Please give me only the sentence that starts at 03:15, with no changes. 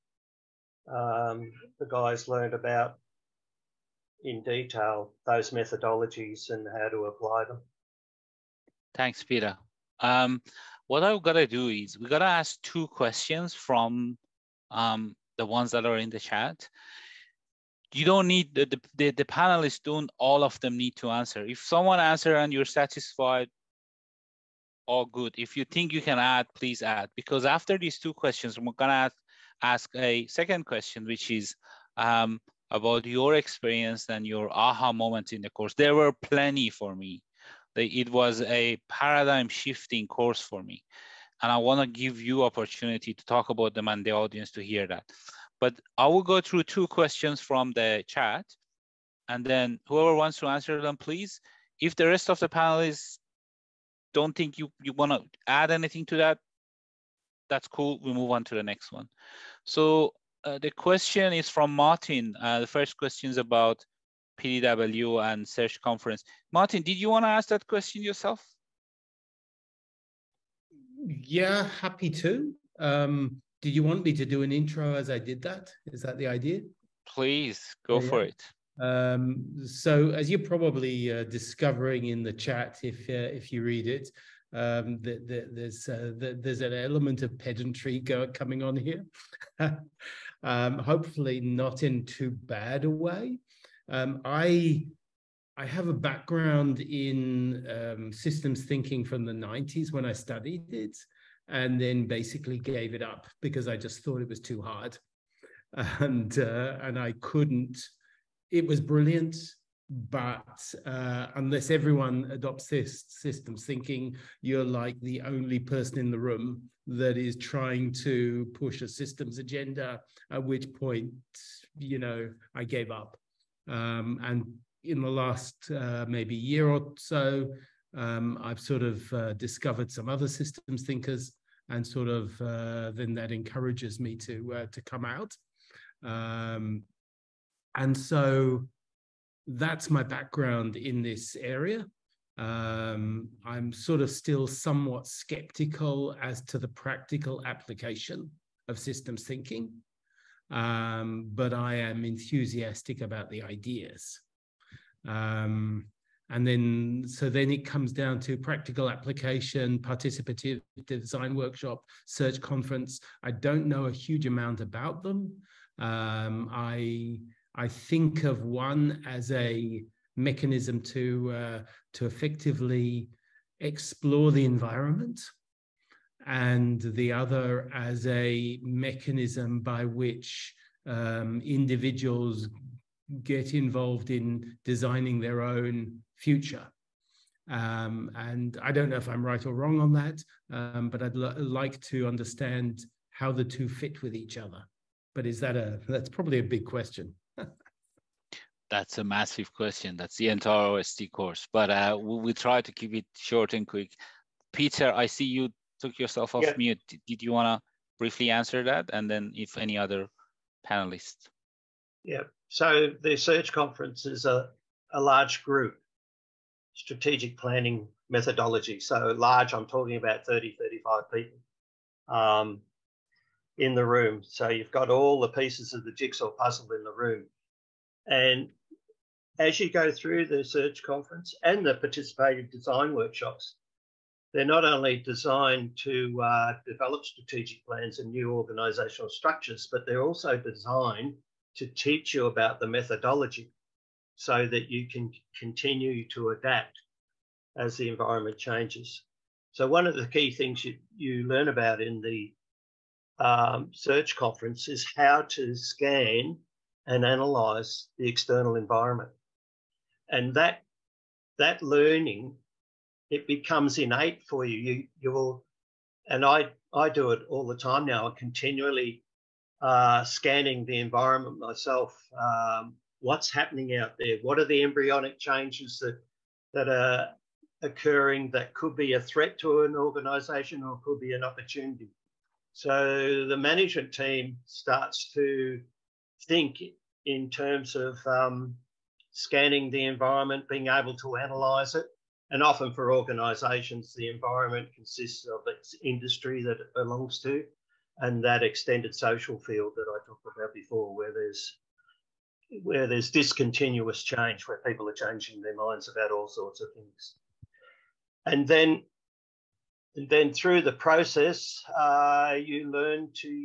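But is that a that's probably a big question?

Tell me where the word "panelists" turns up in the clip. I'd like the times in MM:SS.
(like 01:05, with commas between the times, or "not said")
00:19, 00:52, 03:30.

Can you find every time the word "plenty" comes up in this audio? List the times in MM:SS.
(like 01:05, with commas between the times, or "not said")
00:36.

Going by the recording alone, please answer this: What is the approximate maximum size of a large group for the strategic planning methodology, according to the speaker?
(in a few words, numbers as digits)
35.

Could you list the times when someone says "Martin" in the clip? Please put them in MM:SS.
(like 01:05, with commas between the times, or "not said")
01:01, 01:06.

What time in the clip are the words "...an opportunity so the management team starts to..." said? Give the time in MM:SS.
04:41.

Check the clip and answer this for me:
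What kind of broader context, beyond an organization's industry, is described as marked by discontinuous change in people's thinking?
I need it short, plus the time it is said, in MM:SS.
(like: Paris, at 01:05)
extended social field, at 04:58.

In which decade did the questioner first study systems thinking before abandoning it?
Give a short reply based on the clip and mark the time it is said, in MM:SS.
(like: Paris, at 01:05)
1990s, at 01:39.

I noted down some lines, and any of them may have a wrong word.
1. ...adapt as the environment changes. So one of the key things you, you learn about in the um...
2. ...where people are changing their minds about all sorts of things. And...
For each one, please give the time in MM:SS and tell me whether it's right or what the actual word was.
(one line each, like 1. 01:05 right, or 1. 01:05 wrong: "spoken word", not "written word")
1. 04:06 right
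2. 05:04 right.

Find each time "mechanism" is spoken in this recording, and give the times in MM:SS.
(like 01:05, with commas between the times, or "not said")
02:50, 02:58.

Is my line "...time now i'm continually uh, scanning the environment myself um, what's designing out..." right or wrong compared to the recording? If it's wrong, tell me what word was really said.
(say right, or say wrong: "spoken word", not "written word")
wrong: "happening", not "designing".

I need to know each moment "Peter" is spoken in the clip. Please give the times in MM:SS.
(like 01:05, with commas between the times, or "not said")
00:09, 03:24.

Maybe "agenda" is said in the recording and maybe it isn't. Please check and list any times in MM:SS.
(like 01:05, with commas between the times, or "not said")
01:59.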